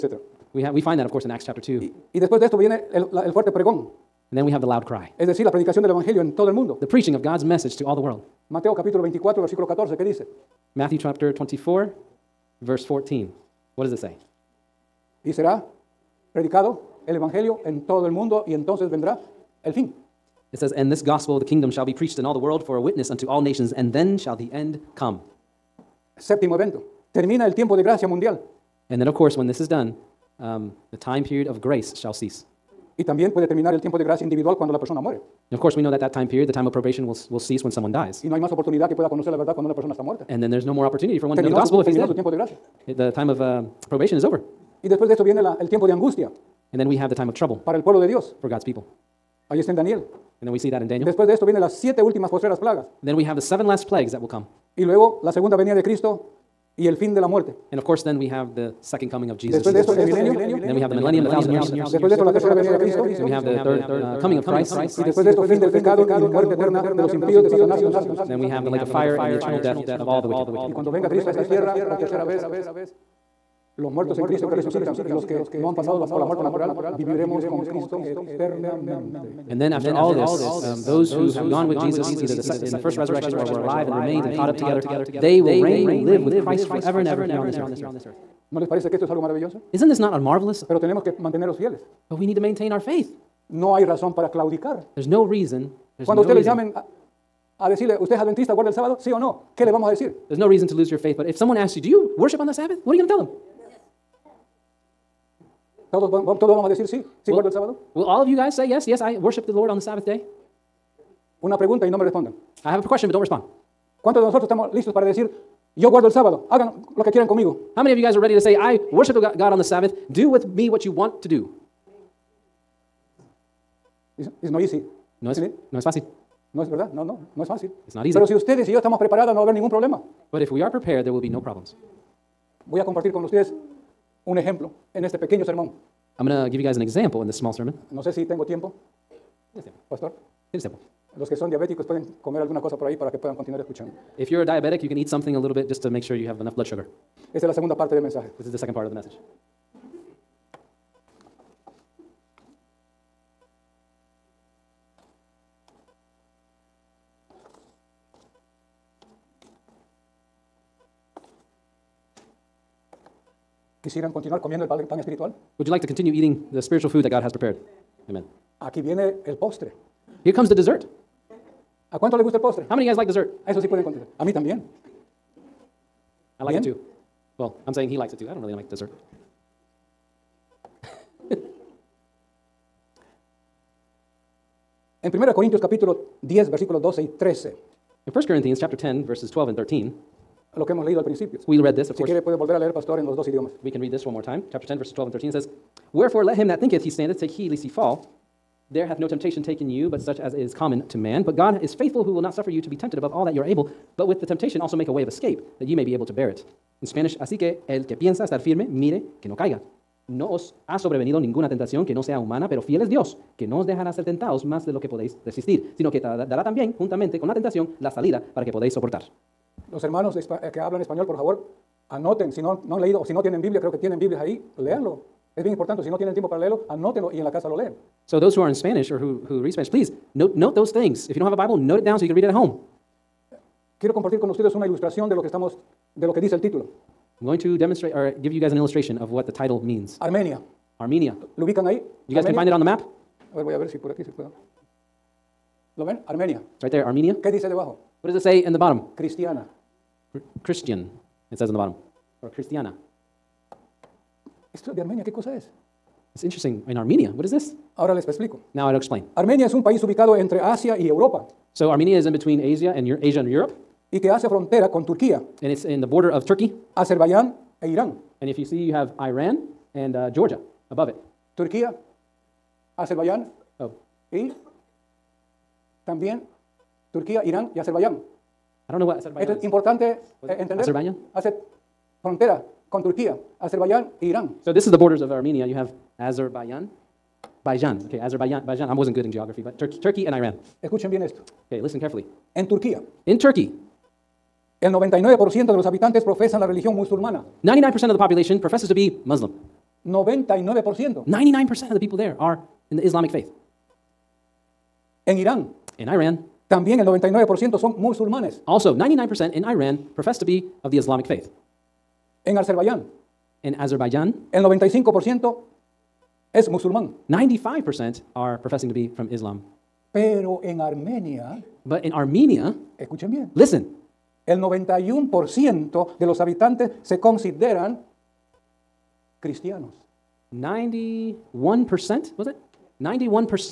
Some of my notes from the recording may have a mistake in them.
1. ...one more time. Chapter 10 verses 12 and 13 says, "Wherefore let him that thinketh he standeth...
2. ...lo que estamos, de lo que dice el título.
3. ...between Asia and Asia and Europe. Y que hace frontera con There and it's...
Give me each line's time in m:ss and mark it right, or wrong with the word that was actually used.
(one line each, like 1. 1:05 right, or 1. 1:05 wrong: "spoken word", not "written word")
1. 3:14 right
2. 3:55 right
3. 4:22 wrong: "Turquía", not "There".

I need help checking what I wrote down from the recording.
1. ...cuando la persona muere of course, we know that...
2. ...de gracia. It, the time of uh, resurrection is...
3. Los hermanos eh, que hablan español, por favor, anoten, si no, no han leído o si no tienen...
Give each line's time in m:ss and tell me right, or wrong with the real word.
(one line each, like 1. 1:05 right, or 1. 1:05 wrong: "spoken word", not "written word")
1. 0:34 right
2. 0:42 wrong: "probation", not "resurrection"
3. 3:39 right.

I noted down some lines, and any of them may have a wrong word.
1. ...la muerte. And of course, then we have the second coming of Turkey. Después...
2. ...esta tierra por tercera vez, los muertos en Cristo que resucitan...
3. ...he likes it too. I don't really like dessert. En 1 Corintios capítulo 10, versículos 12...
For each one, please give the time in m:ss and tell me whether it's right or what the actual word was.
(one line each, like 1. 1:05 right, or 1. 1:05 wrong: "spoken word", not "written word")
1. 0:57 wrong: "Jesus", not "Turkey"
2. 1:11 right
3. 2:57 right.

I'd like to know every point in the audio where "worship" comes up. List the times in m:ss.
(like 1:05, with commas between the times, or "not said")
1:42, 1:49, 1:58.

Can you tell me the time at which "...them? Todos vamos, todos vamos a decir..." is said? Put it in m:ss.
1:43.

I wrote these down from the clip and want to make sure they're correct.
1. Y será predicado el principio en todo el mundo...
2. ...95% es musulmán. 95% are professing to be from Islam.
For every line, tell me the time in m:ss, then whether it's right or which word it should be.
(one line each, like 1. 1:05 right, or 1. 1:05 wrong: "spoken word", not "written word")
1. 0:15 wrong: "evangelio", not "principio"
2. 5:14 right.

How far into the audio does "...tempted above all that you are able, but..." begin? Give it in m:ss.
3:22.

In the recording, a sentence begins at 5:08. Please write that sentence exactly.
Also, 99% in Iran profess to be of the Islamic faith.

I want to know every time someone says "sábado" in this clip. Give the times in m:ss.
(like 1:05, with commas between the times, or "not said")
1:38, 1:47, 1:56.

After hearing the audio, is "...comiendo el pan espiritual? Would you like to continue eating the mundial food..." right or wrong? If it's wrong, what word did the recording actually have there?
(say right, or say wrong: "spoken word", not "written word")
wrong: "spiritual", not "mundial".